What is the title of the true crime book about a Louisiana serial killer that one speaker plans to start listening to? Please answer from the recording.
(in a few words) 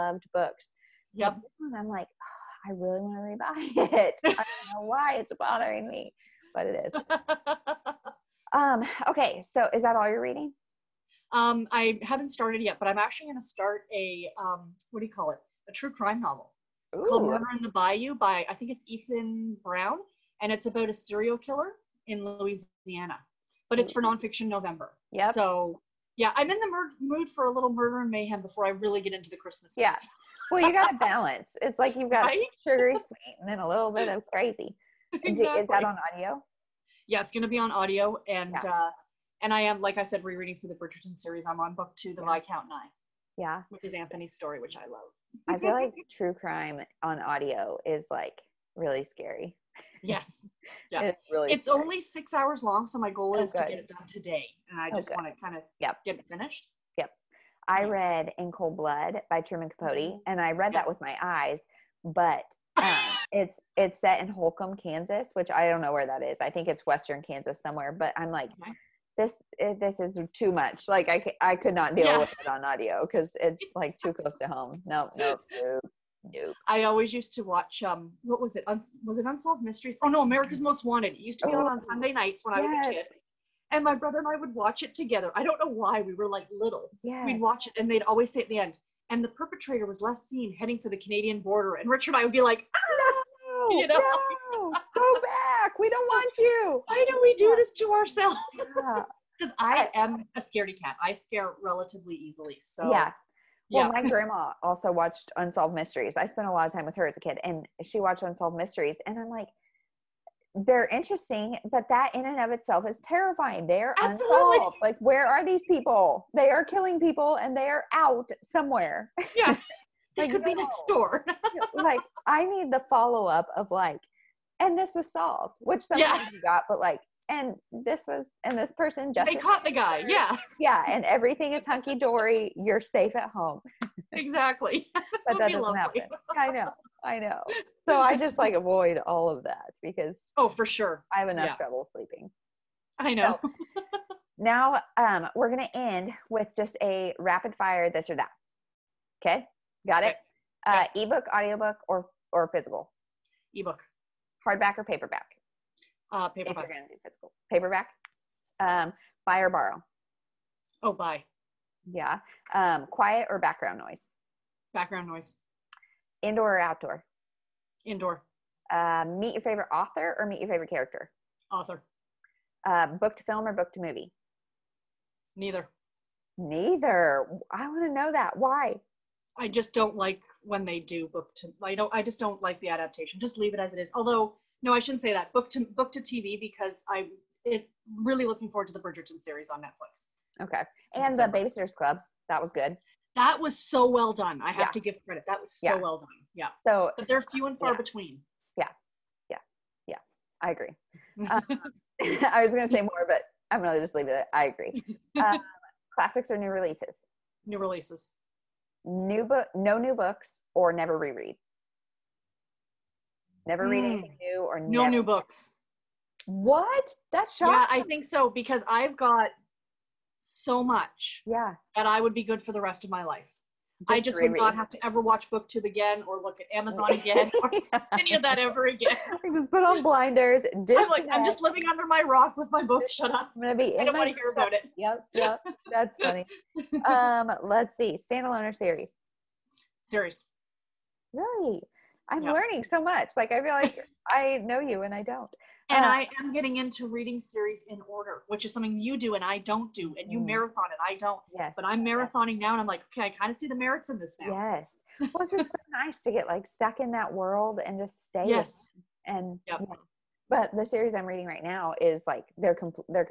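Murder in the Bayou.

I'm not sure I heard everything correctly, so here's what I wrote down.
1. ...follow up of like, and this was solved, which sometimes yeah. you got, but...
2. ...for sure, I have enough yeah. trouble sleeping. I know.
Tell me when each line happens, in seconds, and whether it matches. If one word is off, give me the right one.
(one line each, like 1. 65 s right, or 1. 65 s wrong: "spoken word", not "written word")
1. 122 s right
2. 140 s right.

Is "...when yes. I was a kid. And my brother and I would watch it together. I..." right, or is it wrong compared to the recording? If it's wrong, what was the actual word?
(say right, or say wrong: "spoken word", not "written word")
right.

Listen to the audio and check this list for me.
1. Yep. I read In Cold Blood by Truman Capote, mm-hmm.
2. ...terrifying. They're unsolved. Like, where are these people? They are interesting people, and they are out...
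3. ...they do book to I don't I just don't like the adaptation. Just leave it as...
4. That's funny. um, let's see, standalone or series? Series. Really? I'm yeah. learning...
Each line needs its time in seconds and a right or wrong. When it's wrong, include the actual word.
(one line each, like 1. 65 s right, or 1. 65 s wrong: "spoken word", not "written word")
1. 56 s right
2. 113 s wrong: "killing", not "interesting"
3. 180 s right
4. 235 s right.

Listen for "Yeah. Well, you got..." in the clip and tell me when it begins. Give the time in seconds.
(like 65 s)
29 s.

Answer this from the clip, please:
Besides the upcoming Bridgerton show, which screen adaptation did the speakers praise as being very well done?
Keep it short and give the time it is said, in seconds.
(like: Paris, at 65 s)
The Babysitter's Club, at 191 s.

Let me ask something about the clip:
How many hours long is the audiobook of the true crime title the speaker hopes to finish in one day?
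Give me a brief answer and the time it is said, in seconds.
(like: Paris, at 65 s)
6, at 52 s.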